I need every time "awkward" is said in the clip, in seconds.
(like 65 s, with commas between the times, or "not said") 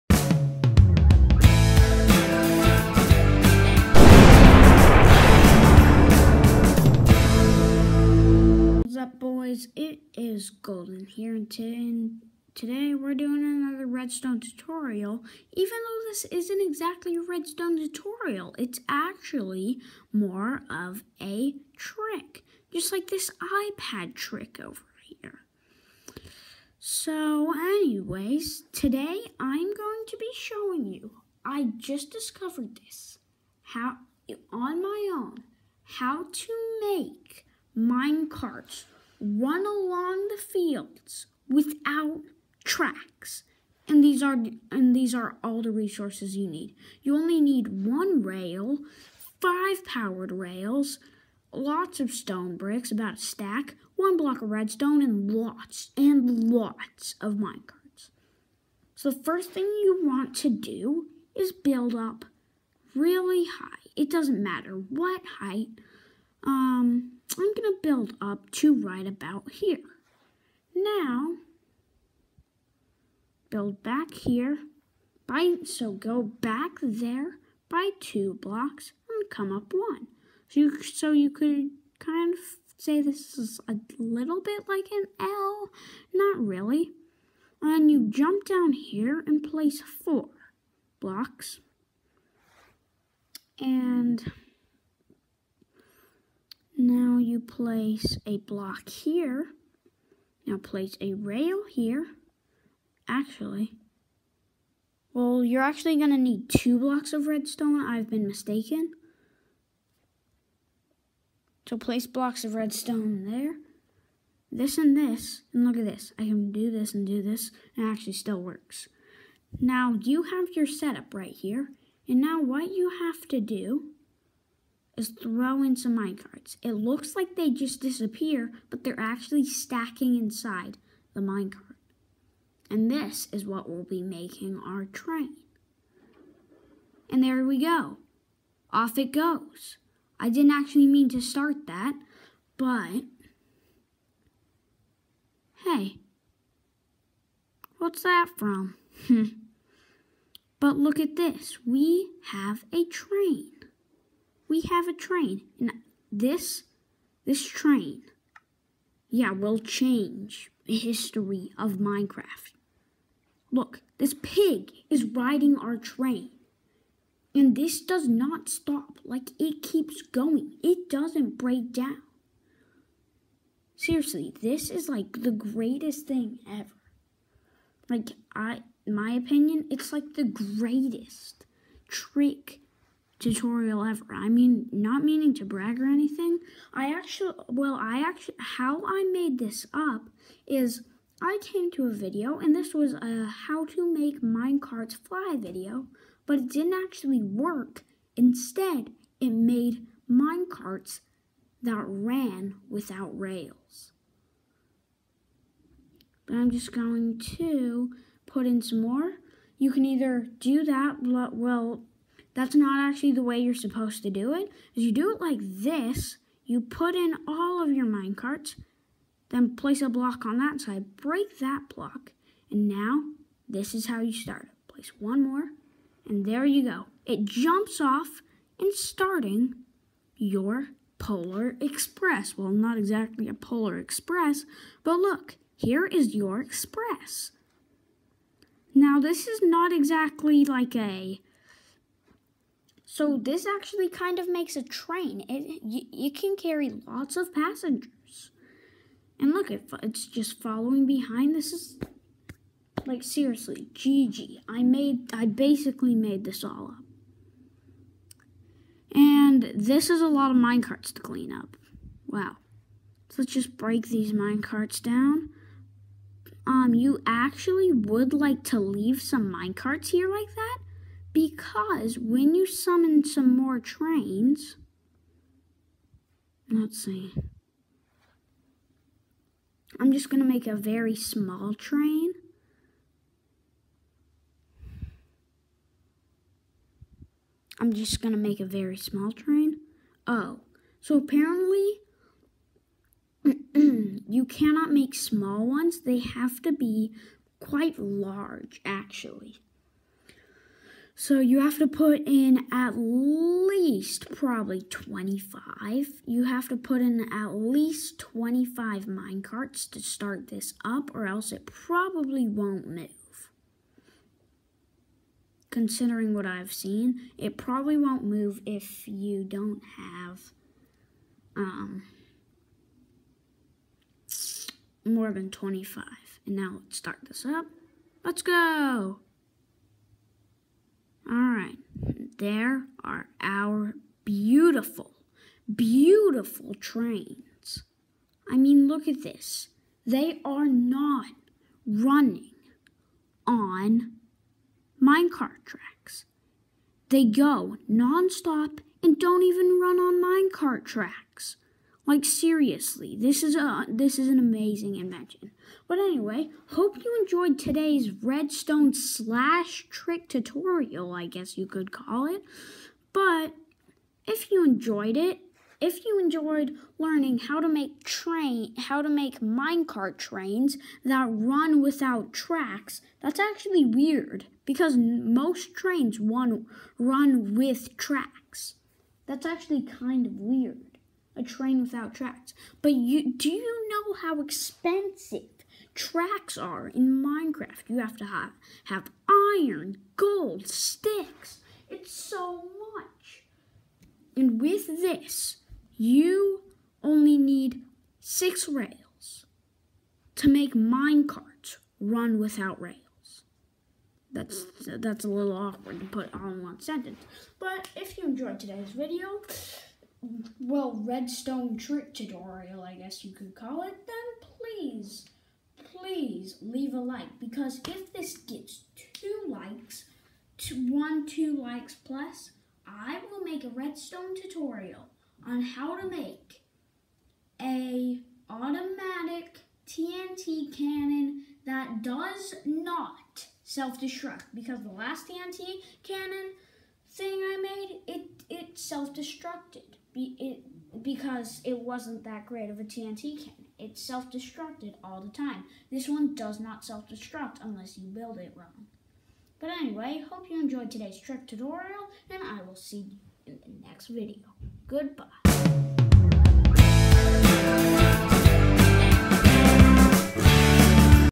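405 s.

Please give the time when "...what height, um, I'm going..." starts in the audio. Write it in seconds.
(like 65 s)
64 s.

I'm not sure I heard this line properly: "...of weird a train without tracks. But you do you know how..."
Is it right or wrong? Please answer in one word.
right.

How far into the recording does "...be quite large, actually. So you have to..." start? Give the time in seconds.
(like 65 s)
296 s.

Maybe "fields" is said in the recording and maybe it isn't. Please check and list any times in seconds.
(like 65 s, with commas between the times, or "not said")
40 s.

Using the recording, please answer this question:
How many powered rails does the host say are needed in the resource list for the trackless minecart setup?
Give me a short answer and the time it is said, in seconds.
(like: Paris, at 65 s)
5, at 49 s.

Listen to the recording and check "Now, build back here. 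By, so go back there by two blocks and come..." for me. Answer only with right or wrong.
right.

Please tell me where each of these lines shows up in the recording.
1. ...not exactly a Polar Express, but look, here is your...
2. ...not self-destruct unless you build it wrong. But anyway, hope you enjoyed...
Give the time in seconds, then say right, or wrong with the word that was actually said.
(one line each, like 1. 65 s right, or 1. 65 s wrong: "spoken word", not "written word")
1. 232 s right
2. 446 s right.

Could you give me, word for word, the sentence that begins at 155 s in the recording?
And this, this train, yeah, will change the history of Minecraft.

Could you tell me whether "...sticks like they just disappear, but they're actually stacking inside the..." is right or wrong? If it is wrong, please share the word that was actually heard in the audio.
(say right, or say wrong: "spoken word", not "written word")
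wrong: "looks", not "sticks".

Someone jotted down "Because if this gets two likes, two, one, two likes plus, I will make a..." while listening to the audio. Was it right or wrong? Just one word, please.
right.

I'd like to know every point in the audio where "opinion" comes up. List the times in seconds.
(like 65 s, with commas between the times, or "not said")
179 s.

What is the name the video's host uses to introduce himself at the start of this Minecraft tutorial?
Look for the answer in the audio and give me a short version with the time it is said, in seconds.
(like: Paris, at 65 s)
Golden, at 10 s.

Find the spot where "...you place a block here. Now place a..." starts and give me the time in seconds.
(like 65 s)
97 s.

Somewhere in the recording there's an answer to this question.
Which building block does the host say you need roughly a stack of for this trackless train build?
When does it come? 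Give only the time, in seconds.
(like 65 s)
52 s.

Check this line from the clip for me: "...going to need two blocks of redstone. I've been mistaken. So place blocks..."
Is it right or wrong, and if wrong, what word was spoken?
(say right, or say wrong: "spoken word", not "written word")
right.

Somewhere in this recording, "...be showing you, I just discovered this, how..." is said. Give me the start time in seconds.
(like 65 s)
30 s.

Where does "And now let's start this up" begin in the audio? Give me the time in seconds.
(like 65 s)
326 s.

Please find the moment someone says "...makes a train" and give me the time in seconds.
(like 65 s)
244 s.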